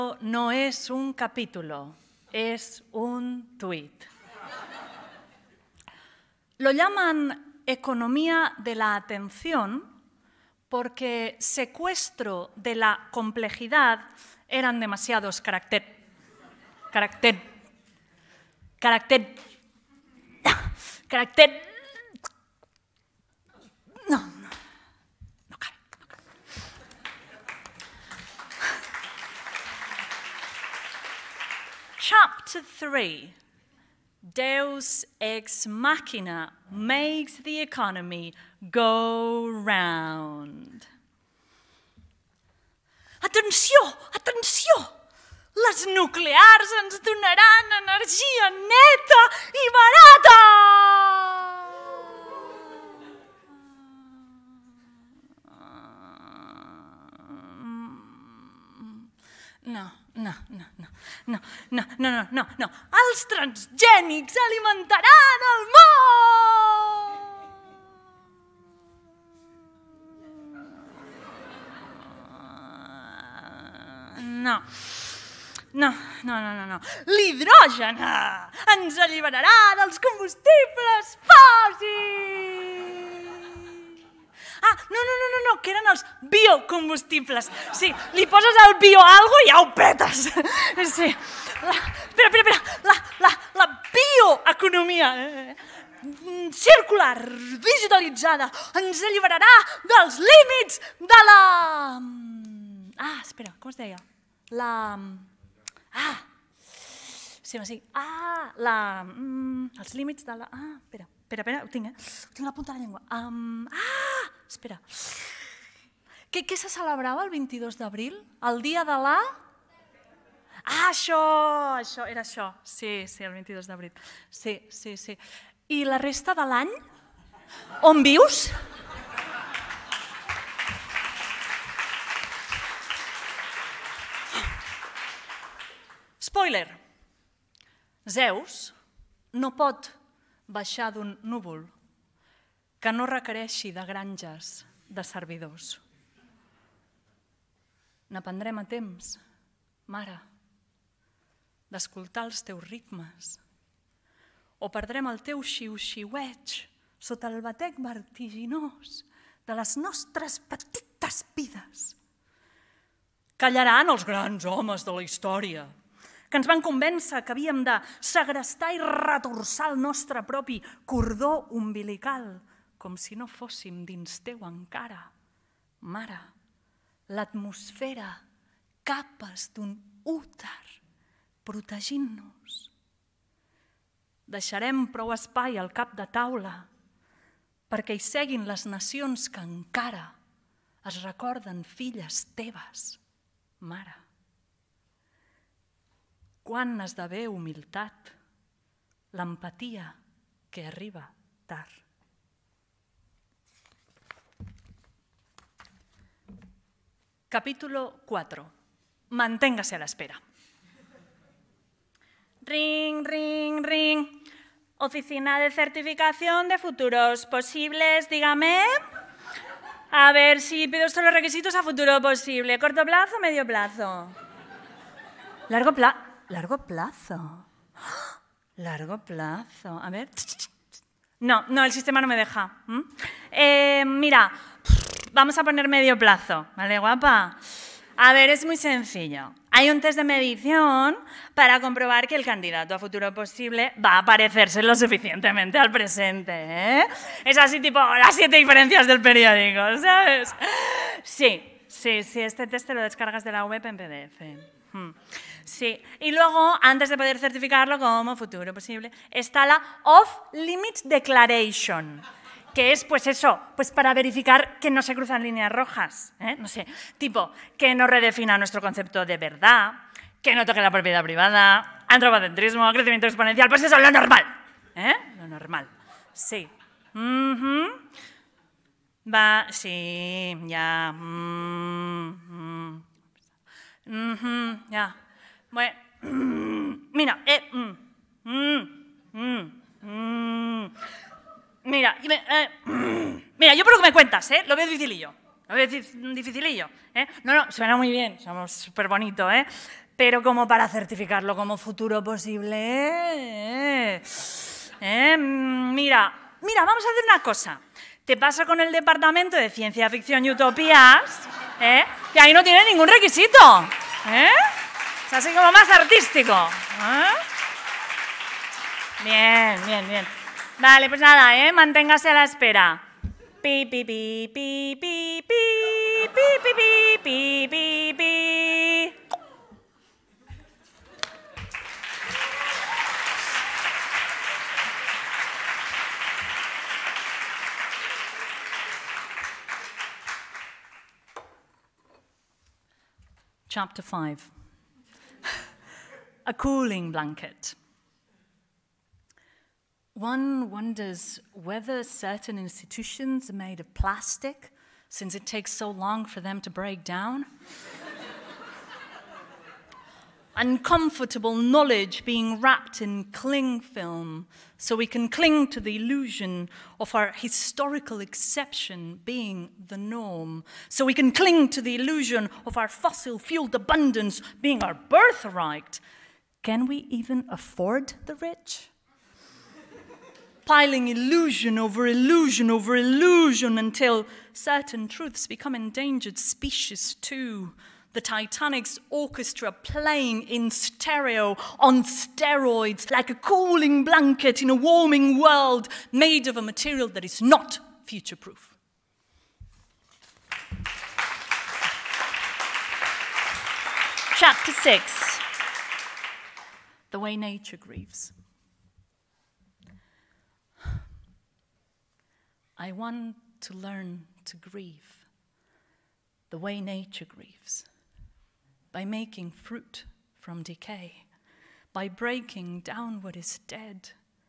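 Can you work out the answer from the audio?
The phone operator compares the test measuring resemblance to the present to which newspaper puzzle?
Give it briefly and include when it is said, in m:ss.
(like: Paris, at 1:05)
las siete diferencias, at 4:07.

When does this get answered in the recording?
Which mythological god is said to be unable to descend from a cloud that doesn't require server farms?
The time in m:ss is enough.
2:18.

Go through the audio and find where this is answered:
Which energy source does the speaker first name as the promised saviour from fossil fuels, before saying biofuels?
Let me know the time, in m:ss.
1:17.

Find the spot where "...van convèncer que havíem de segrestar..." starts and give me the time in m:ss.
2:46.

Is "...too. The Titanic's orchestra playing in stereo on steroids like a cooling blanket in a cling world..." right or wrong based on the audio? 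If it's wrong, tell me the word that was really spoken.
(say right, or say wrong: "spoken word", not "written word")
wrong: "warming", not "cling".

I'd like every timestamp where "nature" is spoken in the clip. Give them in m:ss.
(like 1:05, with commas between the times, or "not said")
6:47, 6:56.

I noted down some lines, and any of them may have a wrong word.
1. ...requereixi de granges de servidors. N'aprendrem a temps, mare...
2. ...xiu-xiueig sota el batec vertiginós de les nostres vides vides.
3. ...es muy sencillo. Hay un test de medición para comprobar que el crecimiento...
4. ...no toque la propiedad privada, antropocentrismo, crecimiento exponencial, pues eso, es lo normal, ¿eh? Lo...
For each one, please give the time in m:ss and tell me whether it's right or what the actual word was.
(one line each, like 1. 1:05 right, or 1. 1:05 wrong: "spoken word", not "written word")
1. 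2:23 right
2. 2:35 wrong: "petites", not "vides"
3. 3:58 wrong: "candidato", not "crecimiento"
4. 4:30 right.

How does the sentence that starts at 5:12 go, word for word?
Que ahí no tiene ningún requisito, ¿eh?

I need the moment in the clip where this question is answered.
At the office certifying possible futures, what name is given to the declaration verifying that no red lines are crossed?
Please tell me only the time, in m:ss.
4:19.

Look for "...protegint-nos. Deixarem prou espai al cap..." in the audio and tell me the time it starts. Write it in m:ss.
3:01.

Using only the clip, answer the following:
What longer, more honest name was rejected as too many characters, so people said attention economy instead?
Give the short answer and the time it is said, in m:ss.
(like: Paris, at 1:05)
secuestro de la complejidad, at 0:11.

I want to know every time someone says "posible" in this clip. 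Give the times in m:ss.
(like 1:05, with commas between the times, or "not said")
3:37, 3:41, 4:03, 4:18, 5:02.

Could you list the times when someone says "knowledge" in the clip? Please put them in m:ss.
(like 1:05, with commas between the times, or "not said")
6:01.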